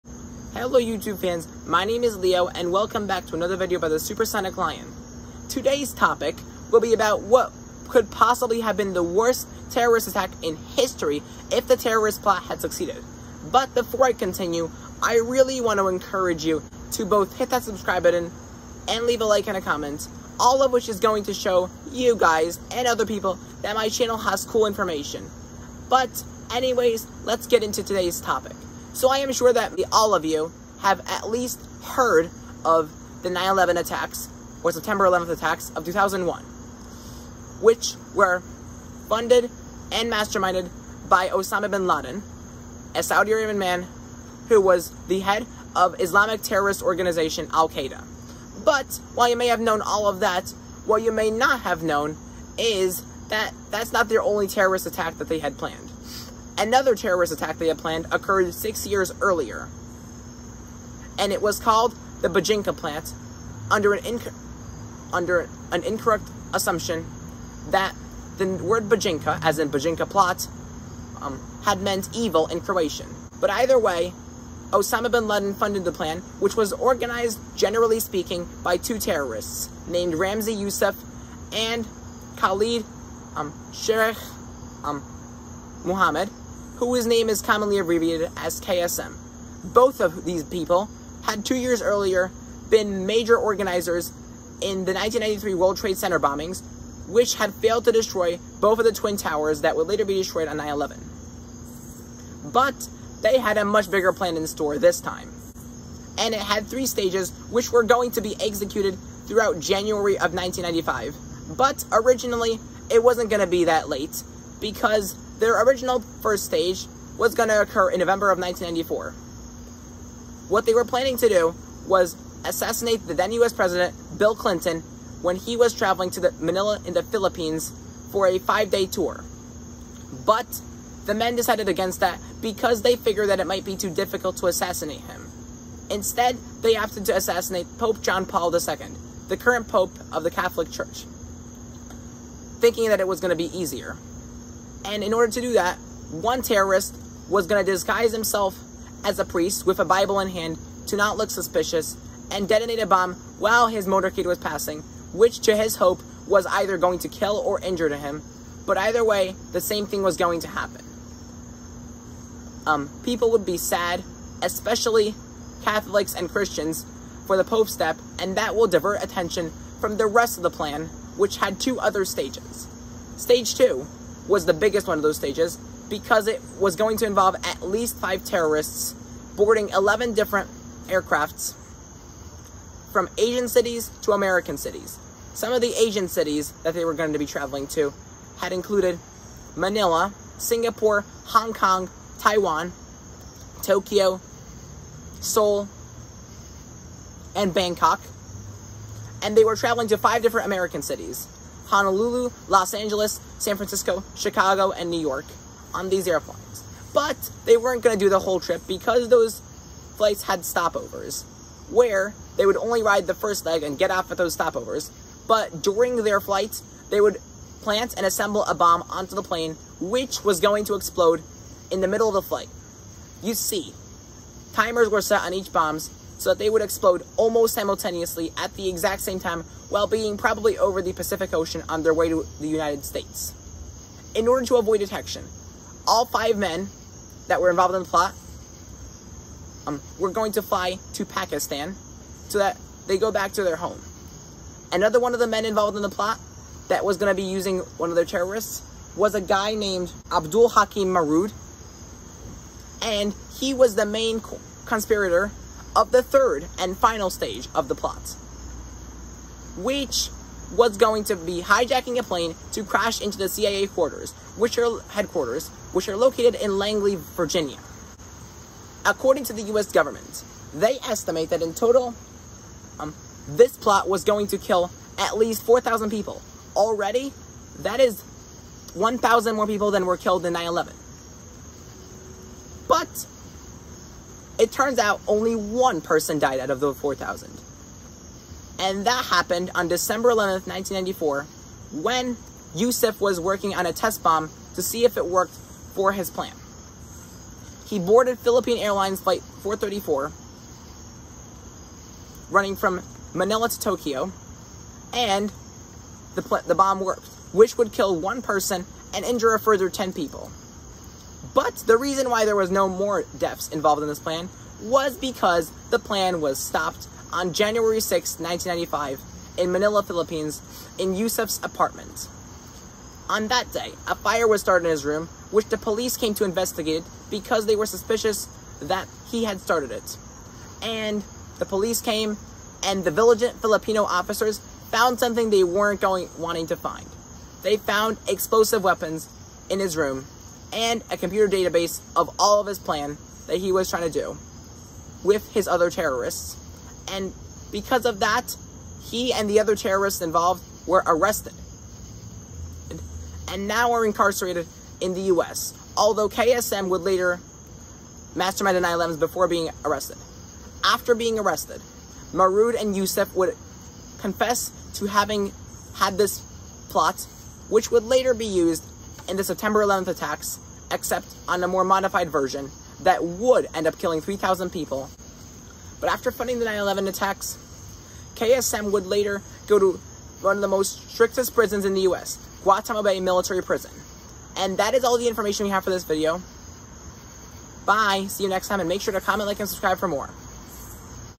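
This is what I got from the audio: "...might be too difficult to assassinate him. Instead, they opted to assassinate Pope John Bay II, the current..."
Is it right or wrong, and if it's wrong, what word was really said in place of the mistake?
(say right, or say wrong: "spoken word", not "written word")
wrong: "Paul", not "Bay".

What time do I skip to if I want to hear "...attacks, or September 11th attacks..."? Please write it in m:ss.
0:33.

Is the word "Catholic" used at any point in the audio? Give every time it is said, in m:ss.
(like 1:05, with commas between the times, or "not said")
2:20, 2:45.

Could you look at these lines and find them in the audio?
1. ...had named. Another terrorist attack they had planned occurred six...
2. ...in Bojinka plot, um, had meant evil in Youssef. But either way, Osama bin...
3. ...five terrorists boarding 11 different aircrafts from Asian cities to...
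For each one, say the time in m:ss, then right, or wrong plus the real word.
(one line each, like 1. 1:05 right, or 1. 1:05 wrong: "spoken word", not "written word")
1. 0:55 wrong: "planned", not "named"
2. 1:09 wrong: "Croatian", not "Youssef"
3. 2:57 right.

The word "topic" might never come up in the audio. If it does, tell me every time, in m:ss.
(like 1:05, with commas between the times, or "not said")
0:05, 0:28.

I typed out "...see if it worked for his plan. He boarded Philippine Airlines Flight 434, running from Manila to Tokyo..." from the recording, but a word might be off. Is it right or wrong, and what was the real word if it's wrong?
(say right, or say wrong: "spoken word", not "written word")
right.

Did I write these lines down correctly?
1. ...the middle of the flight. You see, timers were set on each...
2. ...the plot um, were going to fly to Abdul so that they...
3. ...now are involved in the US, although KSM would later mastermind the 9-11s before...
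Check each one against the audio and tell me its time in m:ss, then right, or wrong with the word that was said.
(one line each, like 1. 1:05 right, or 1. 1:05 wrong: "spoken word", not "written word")
1. 3:41 right
2. 3:57 wrong: "Pakistan", not "Abdul"
3. 5:53 wrong: "incarcerated", not "involved".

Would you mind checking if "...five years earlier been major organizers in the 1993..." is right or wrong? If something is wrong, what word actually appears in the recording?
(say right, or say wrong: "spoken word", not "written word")
wrong: "two", not "five".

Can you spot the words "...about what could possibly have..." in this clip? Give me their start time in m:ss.
0:06.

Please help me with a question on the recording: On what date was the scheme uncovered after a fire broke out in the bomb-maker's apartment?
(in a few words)
January 6, 1995.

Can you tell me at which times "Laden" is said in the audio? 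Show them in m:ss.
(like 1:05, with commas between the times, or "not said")
0:41, 1:15.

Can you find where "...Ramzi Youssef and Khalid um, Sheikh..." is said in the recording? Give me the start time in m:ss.
1:20.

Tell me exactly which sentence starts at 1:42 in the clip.
But they had a much bigger plan in store this time.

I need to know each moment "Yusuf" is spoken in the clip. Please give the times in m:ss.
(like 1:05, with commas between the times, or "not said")
4:52, 5:20, 6:02.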